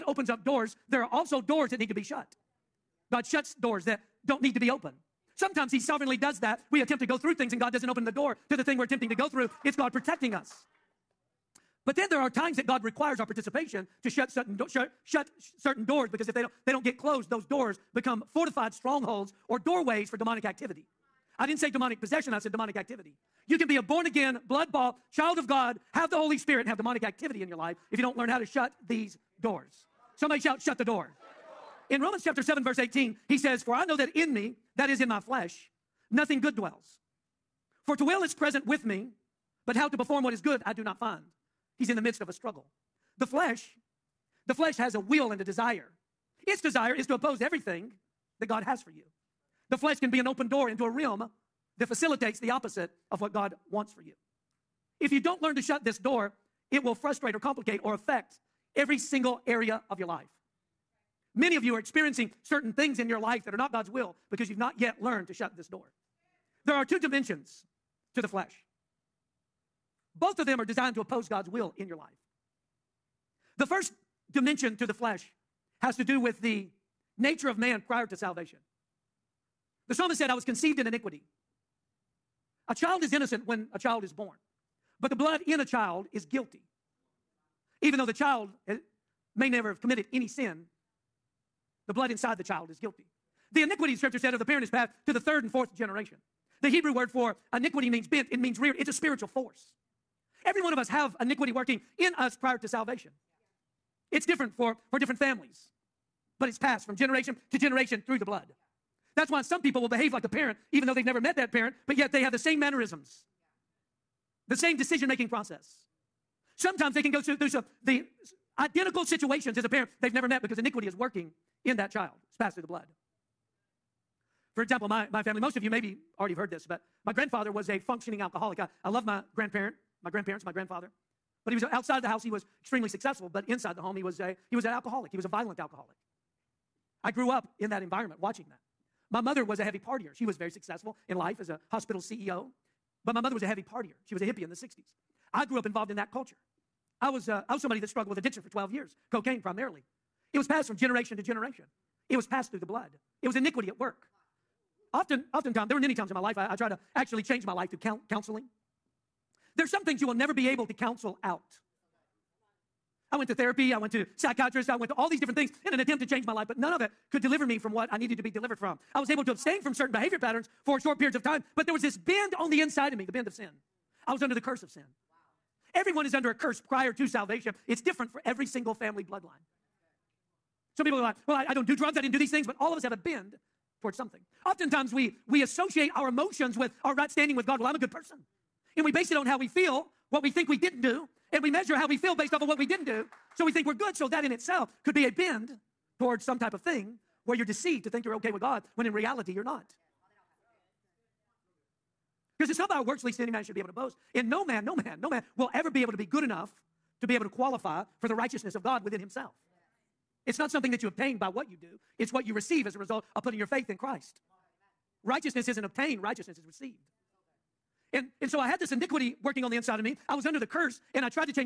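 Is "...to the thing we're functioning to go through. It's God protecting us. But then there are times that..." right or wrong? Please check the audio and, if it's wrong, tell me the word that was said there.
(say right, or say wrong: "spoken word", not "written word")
wrong: "attempting", not "functioning".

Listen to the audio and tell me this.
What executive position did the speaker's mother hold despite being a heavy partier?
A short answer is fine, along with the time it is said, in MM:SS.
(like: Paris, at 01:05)
hospital CEO, at 02:21.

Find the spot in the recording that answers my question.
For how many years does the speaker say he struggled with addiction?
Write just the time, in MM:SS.
02:28.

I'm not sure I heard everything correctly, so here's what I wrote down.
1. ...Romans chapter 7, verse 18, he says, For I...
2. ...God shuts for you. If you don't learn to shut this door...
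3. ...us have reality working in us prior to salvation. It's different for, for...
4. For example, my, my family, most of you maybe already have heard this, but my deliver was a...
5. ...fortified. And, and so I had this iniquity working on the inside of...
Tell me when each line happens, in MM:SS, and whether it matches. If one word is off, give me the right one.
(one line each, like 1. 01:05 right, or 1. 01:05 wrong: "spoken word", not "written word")
1. 00:32 right
2. 00:53 wrong: "wants", not "shuts"
3. 01:40 wrong: "iniquity", not "reality"
4. 02:04 wrong: "grandfather", not "deliver"
5. 03:36 wrong: "received", not "fortified".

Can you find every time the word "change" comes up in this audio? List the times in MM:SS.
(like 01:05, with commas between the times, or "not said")
02:37, 02:46.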